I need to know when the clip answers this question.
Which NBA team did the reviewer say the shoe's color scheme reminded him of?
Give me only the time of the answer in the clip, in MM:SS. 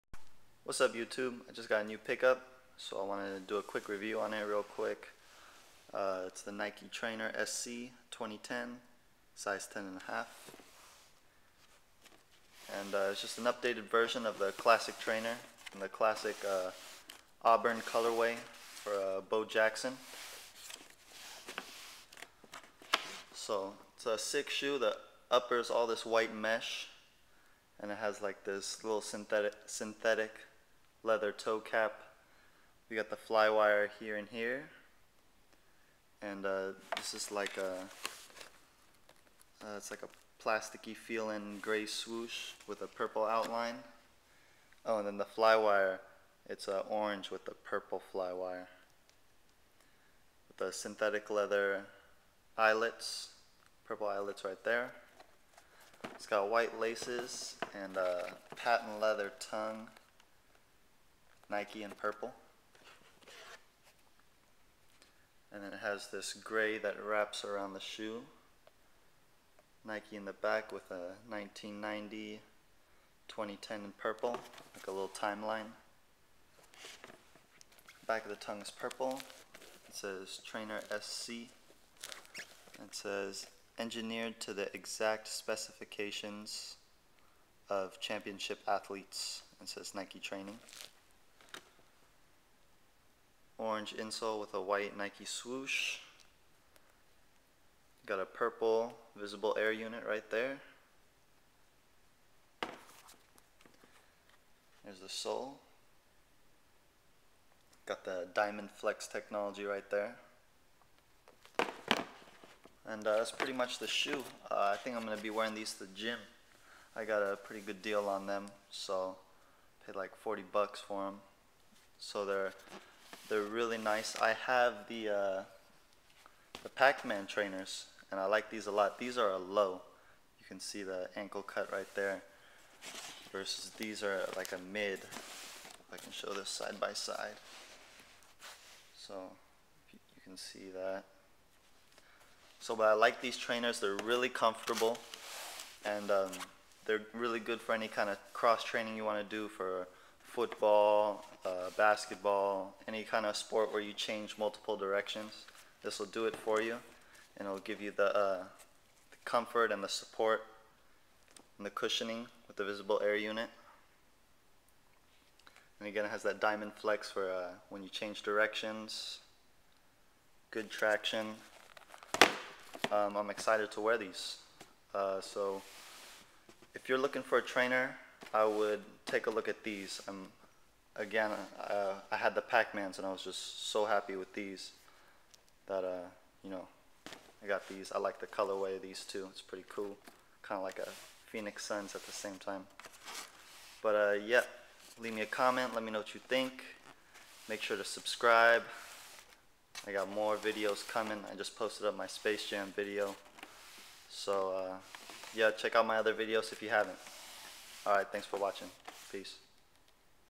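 03:11.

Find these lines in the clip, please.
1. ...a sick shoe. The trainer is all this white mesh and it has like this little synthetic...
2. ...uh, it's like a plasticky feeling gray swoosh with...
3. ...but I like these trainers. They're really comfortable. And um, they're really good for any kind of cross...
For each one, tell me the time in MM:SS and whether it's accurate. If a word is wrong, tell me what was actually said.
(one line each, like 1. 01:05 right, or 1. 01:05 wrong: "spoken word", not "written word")
1. 00:24 wrong: "upper", not "trainer"
2. 00:39 right
3. 02:22 right.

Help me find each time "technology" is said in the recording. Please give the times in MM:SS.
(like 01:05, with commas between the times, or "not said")
01:49.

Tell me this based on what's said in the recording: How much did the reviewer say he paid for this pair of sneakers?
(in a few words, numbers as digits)
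$40.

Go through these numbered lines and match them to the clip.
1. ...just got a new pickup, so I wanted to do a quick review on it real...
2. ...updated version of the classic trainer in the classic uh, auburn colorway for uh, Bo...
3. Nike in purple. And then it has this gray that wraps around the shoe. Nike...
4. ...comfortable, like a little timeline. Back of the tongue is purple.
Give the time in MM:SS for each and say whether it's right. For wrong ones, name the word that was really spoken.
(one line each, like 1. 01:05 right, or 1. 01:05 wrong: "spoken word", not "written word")
1. 00:01 right
2. 00:13 right
3. 01:01 right
4. 01:14 wrong: "purple", not "comfortable".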